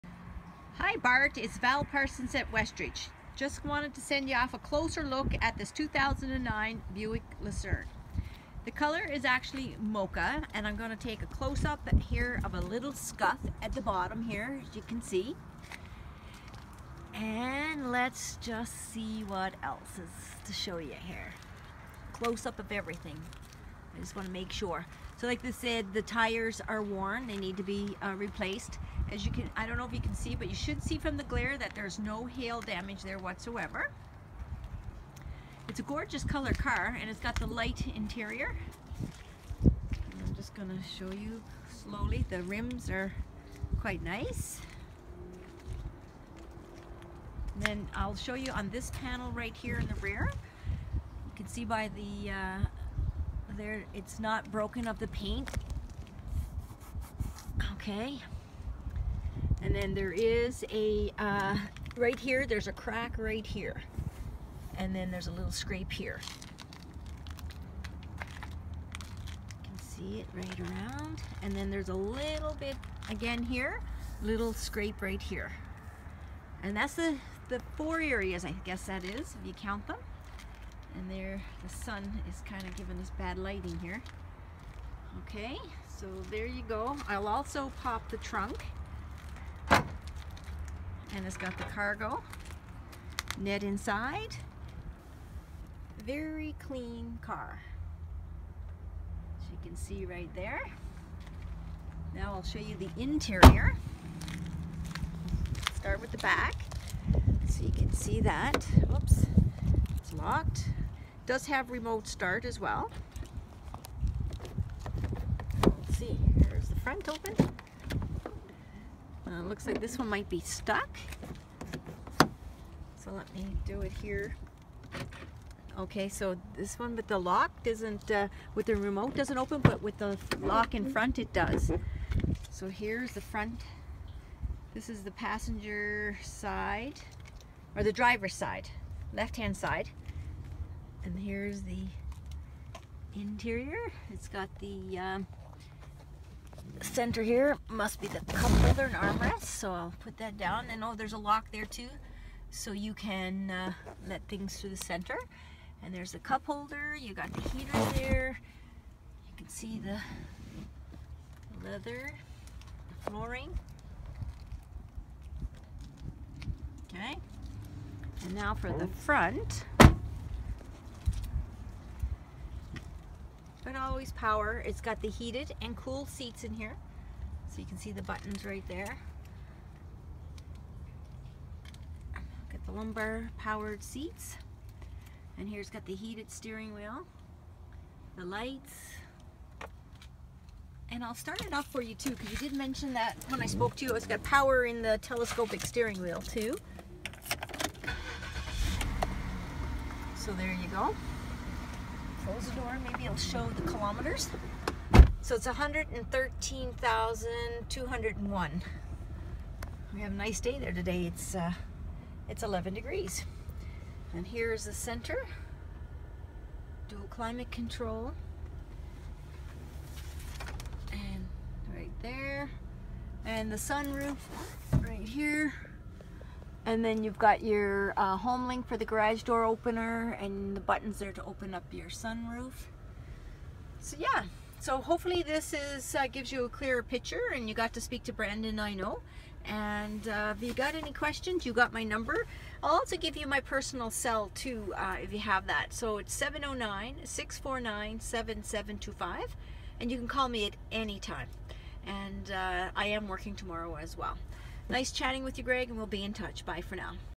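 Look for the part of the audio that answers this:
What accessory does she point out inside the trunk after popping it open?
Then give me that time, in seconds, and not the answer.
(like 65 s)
91 s.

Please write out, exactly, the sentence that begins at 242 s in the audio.
I'll also give you my personal cell too uh, if you have that.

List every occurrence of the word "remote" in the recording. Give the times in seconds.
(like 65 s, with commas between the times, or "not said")
111 s, 128 s.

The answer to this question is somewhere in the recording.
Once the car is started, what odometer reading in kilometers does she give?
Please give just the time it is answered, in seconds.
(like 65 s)
205 s.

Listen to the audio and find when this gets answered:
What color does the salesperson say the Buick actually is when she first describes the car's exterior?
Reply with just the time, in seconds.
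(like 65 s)
9 s.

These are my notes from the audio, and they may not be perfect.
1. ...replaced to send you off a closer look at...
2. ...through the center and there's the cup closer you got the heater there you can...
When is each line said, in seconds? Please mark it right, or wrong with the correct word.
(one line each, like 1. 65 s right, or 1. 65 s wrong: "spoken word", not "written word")
1. 3 s wrong: "wanted", not "replaced"
2. 154 s wrong: "holder", not "closer".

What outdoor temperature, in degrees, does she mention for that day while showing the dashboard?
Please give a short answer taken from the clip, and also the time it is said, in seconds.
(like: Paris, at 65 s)
11, at 212 s.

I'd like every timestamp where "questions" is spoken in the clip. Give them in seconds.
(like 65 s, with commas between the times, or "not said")
240 s.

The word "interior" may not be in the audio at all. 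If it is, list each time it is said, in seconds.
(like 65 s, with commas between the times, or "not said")
37 s, 103 s, 143 s.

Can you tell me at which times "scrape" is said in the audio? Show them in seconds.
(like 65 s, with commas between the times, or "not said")
65 s, 74 s.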